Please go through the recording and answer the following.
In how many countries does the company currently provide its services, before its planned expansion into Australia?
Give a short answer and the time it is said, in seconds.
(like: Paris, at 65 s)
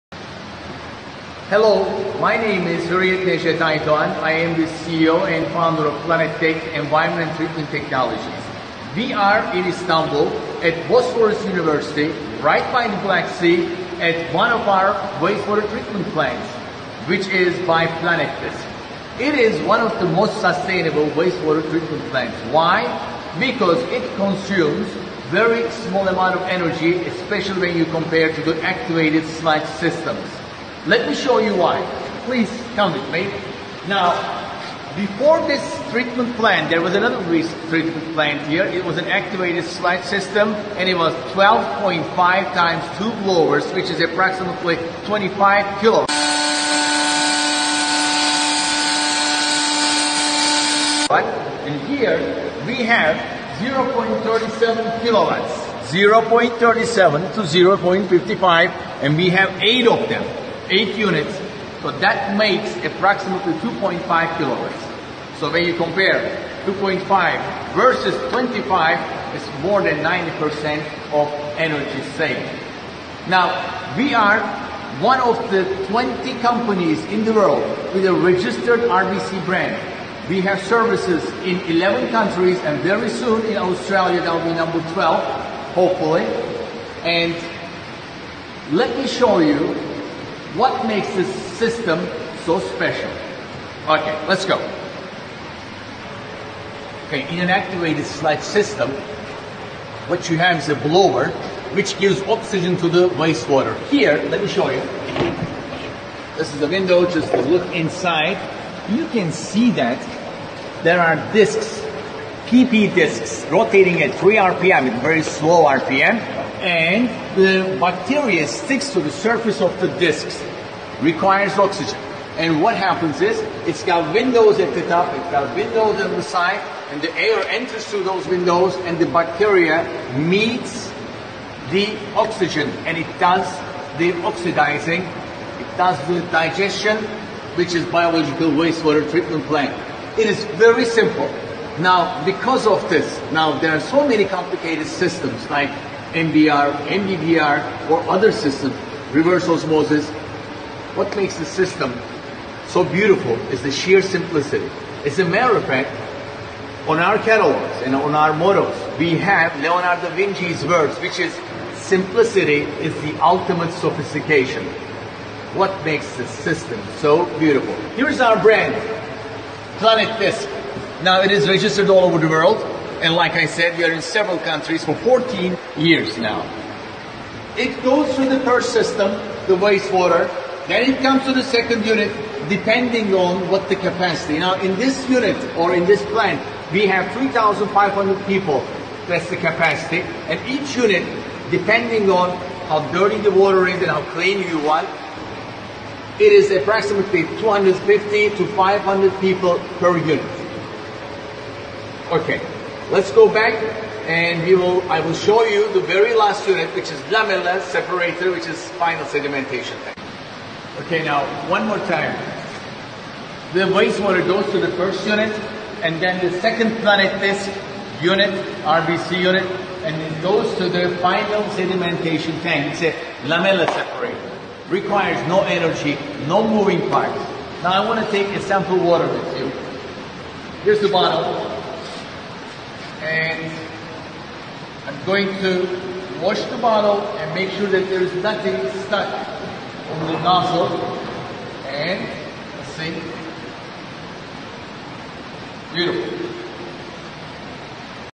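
11, at 81 s.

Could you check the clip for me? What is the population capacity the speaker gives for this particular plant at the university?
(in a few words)
3,500 people.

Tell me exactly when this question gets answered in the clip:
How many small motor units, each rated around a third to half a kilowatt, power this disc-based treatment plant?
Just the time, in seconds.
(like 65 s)
59 s.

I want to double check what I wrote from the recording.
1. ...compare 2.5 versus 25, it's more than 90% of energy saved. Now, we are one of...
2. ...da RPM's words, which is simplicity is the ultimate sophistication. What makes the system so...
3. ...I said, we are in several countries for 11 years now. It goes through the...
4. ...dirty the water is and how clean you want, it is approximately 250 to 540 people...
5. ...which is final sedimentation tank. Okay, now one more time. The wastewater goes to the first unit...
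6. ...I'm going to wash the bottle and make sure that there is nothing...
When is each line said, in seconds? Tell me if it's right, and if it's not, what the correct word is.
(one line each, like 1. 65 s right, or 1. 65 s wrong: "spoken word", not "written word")
1. 65 s right
2. 160 s wrong: "Vinci", not "RPM"
3. 173 s wrong: "14", not "11"
4. 192 s wrong: "500", not "540"
5. 208 s right
6. 234 s right.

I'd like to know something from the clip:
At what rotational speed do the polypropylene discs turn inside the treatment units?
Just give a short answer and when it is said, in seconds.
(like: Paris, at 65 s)
3 RPM, at 114 s.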